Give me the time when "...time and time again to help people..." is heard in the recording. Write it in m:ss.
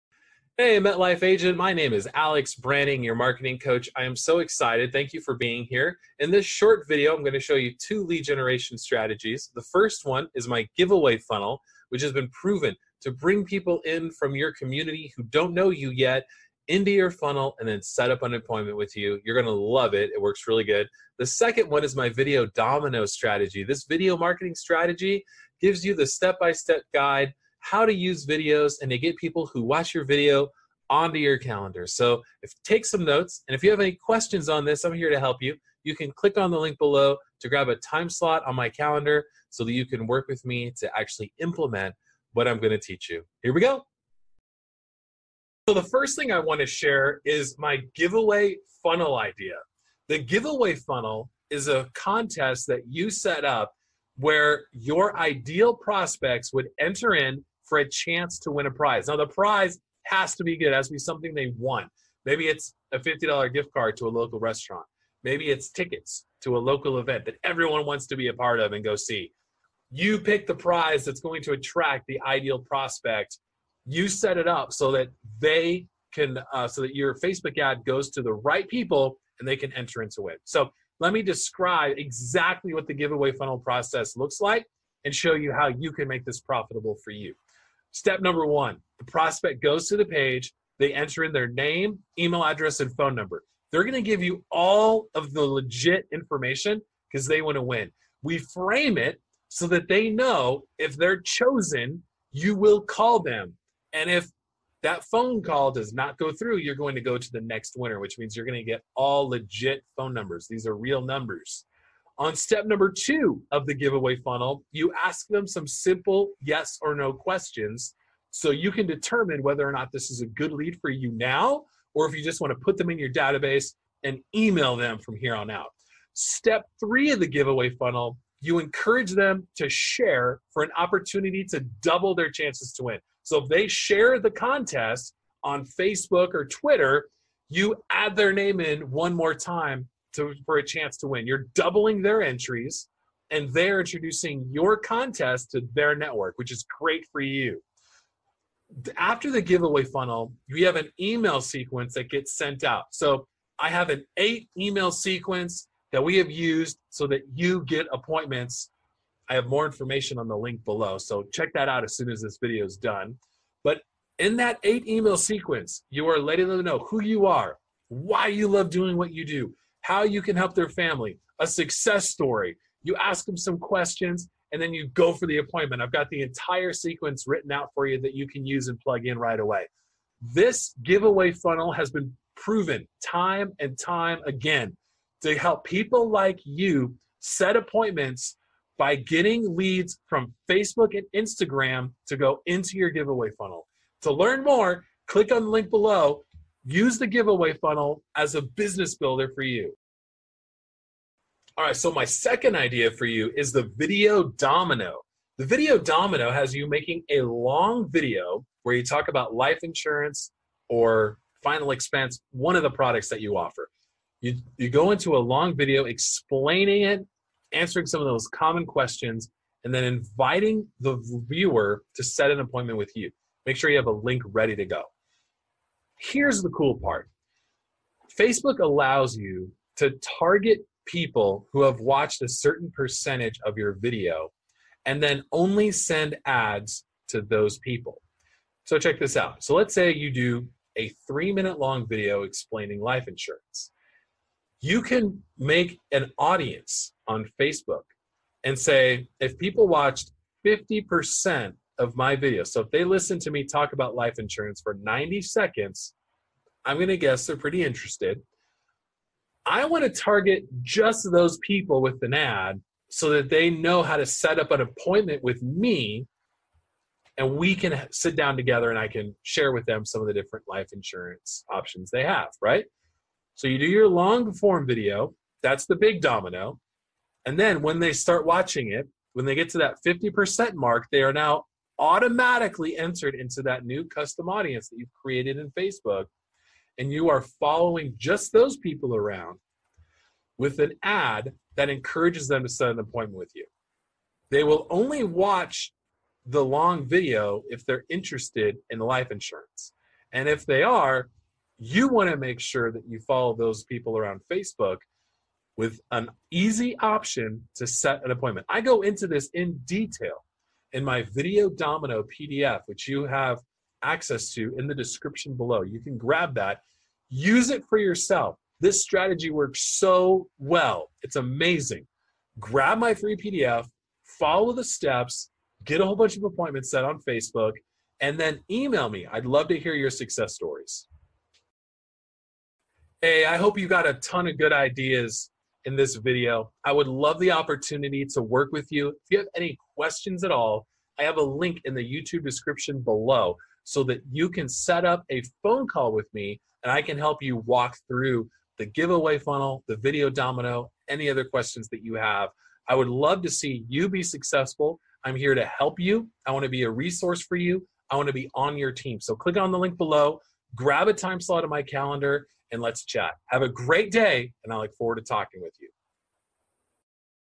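3:03.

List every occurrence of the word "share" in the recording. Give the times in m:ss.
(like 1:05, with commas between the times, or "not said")
0:46, 2:09, 2:13, 4:29.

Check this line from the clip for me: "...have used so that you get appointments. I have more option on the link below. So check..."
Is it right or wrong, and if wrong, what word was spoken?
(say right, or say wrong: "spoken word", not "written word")
wrong: "information", not "option".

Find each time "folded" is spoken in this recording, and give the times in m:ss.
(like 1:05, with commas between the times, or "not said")
not said.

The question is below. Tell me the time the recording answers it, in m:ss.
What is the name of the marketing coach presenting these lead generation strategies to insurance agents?
0:02.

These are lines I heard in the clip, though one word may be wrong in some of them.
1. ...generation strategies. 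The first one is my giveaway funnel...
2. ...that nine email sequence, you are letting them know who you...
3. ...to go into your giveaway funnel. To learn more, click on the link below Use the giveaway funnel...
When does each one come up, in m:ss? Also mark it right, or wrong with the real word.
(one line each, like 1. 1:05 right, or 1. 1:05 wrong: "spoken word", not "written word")
1. 0:08 right
2. 2:44 wrong: "eight", not "nine"
3. 3:12 right.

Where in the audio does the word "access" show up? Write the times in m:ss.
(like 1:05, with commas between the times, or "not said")
5:13.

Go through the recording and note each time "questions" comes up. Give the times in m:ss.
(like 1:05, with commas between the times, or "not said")
0:33, 1:57, 2:53, 3:38, 5:39, 5:51.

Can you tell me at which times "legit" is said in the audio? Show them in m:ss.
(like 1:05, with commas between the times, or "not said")
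1:35, 1:49.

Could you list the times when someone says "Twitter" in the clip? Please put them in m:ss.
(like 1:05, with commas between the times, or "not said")
2:16.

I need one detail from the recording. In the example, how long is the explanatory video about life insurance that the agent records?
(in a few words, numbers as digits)
3 minutes.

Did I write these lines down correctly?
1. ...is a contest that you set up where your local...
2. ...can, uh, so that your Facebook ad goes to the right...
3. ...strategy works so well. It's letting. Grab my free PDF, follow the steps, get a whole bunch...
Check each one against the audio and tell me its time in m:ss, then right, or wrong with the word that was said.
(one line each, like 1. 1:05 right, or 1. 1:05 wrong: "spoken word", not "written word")
1. 0:51 wrong: "ideal", not "local"
2. 1:16 right
3. 5:18 wrong: "amazing", not "letting".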